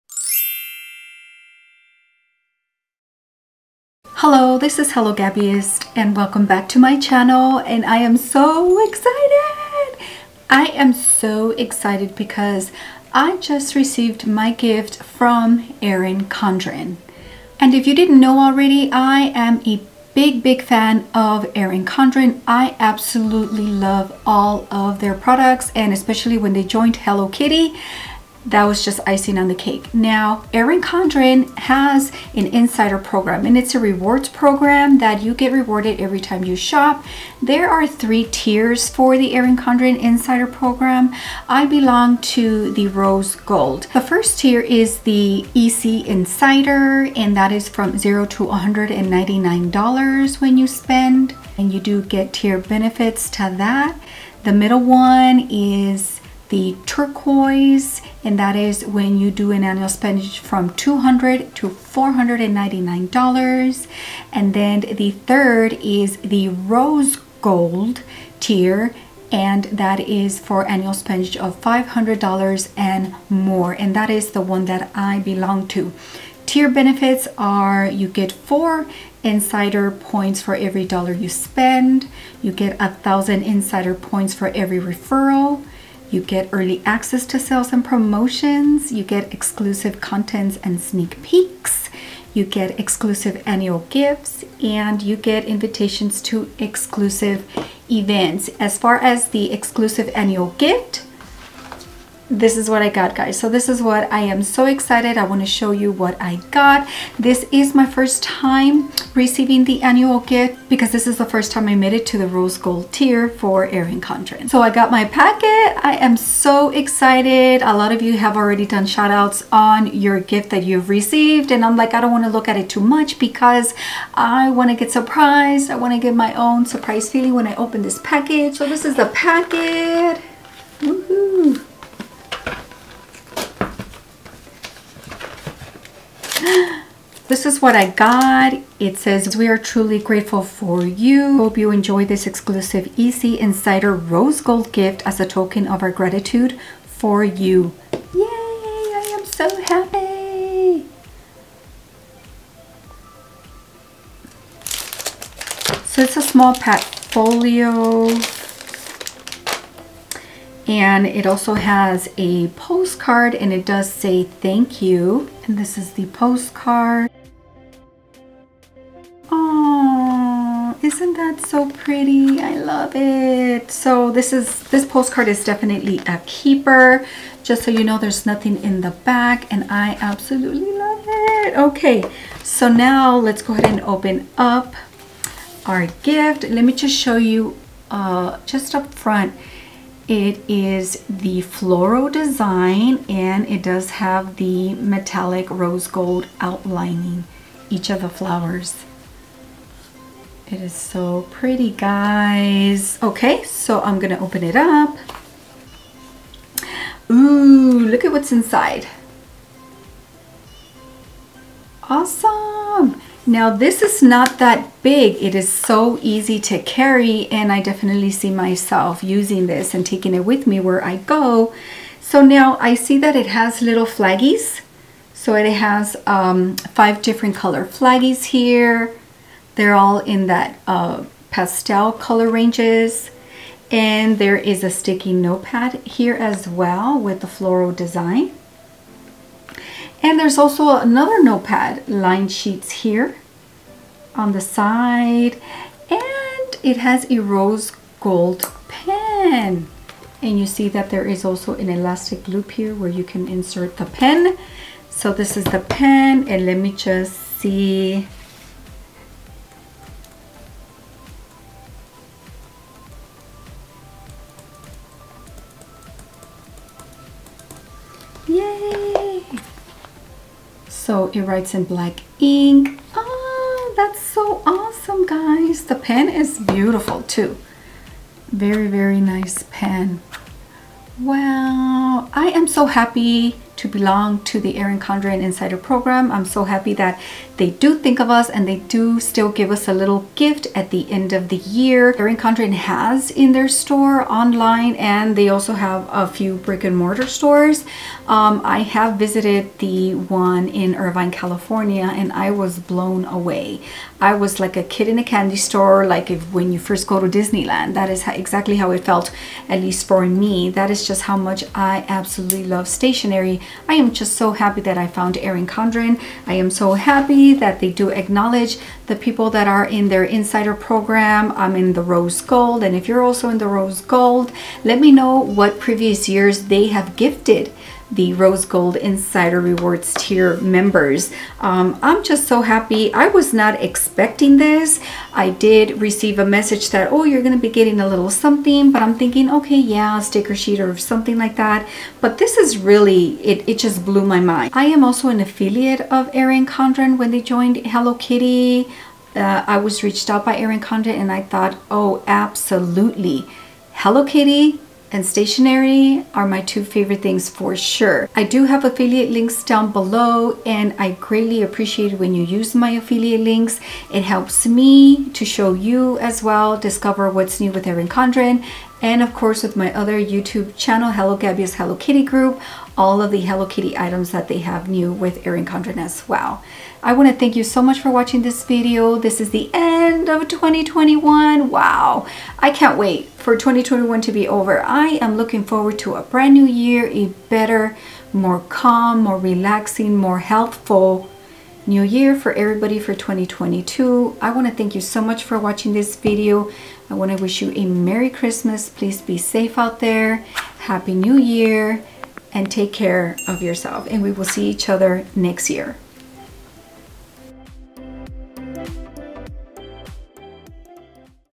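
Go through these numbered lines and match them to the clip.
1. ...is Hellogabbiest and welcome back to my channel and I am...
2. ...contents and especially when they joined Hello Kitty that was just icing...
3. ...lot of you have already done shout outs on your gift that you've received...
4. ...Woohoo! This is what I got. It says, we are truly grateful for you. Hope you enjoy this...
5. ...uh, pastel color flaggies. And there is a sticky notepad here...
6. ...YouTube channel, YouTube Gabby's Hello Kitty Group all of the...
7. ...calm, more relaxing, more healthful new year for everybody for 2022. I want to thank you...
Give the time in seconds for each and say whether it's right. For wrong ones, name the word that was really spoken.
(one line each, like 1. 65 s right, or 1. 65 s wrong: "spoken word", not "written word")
1. 4 s right
2. 25 s wrong: "products", not "contents"
3. 117 s right
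4. 130 s right
5. 230 s wrong: "ranges", not "flaggies"
6. 369 s wrong: "Hello", not "YouTube"
7. 388 s right.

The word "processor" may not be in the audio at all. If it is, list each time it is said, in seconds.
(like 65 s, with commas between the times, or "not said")
not said.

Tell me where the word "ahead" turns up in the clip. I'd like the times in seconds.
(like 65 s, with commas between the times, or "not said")
183 s.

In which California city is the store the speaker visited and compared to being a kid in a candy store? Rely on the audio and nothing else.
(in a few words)
Irvine.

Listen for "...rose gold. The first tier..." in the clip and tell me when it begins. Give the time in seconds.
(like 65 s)
42 s.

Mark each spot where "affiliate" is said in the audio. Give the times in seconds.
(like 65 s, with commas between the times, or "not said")
345 s, 358 s, 362 s.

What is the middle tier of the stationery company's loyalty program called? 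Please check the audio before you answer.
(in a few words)
Turquoise.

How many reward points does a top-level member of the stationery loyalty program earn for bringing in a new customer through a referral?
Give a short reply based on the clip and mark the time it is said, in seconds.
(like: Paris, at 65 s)
1000, at 82 s.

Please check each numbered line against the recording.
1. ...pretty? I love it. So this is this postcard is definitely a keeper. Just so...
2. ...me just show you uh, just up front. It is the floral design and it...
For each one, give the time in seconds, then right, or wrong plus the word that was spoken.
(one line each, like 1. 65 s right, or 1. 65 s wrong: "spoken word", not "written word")
1. 171 s right
2. 186 s right.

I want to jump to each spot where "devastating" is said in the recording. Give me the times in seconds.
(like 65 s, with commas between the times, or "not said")
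not said.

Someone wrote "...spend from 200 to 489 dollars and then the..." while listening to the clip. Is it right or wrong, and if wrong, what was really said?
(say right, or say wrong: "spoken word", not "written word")
wrong: "499", not "489".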